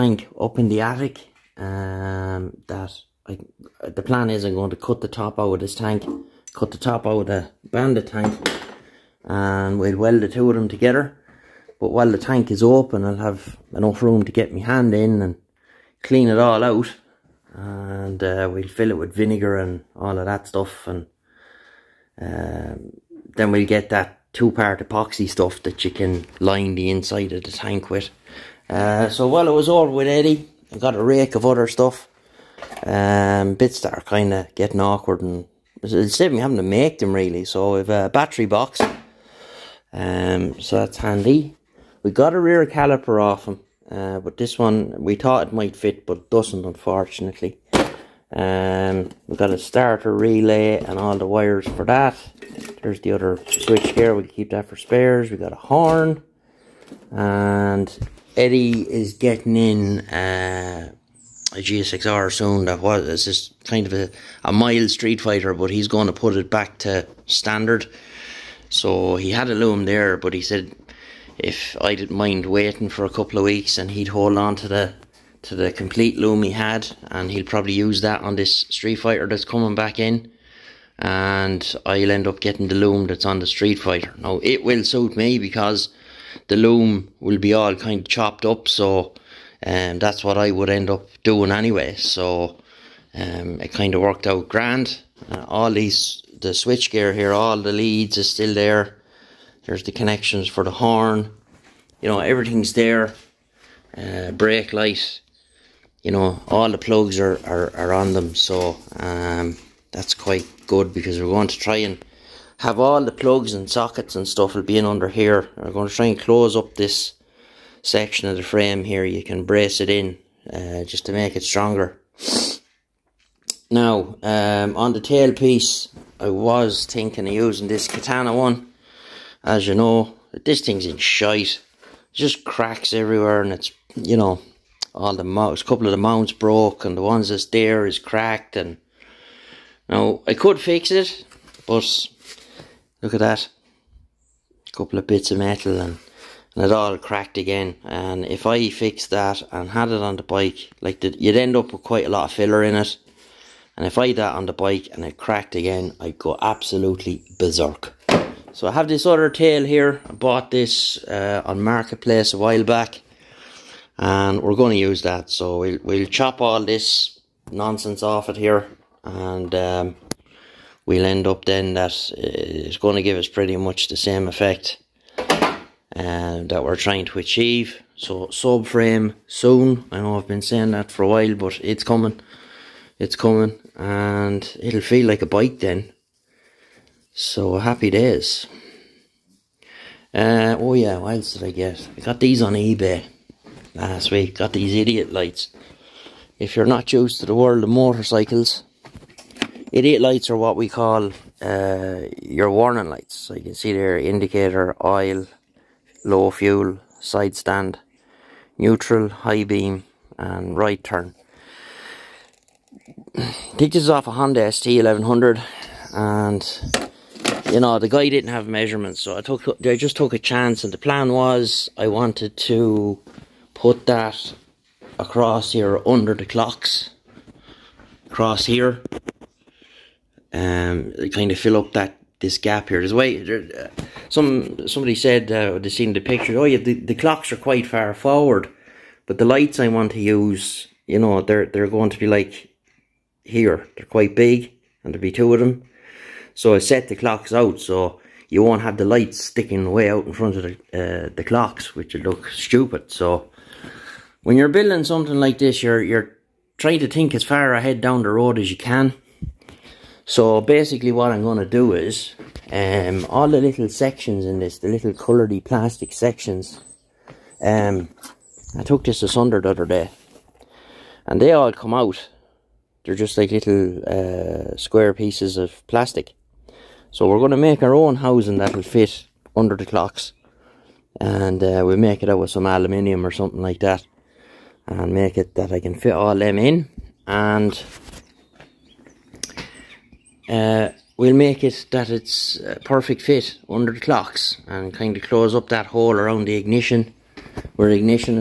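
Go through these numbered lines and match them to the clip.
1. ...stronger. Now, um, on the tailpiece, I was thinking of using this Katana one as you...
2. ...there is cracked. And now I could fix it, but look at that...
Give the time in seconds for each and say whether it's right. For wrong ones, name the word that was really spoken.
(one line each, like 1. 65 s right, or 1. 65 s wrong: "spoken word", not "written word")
1. 121 s right
2. 137 s right.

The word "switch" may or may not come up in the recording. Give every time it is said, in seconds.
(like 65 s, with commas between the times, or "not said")
53 s, 96 s.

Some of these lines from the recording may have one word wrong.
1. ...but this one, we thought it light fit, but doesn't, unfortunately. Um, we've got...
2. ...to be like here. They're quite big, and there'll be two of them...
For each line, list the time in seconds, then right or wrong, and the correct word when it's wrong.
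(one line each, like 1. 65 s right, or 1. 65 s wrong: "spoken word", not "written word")
1. 44 s wrong: "might", not "light"
2. 241 s right.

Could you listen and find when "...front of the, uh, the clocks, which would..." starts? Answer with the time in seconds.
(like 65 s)
250 s.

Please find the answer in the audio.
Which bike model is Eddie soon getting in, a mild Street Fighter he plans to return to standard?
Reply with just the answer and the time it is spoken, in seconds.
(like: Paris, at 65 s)
GSXR, at 61 s.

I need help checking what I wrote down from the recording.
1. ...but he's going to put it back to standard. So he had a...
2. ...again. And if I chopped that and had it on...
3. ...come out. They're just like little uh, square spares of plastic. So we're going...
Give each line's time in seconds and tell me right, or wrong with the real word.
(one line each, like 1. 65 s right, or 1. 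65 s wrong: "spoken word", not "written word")
1. 65 s right
2. 147 s wrong: "fixed", not "chopped"
3. 271 s wrong: "pieces", not "spares".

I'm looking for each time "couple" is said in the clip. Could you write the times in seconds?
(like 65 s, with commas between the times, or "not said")
73 s, 135 s, 144 s.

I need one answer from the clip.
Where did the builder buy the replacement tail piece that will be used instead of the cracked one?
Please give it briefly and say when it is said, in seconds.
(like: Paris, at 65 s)
Marketplace, at 161 s.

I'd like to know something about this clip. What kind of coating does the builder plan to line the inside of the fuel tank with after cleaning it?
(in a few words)
two-part epoxy.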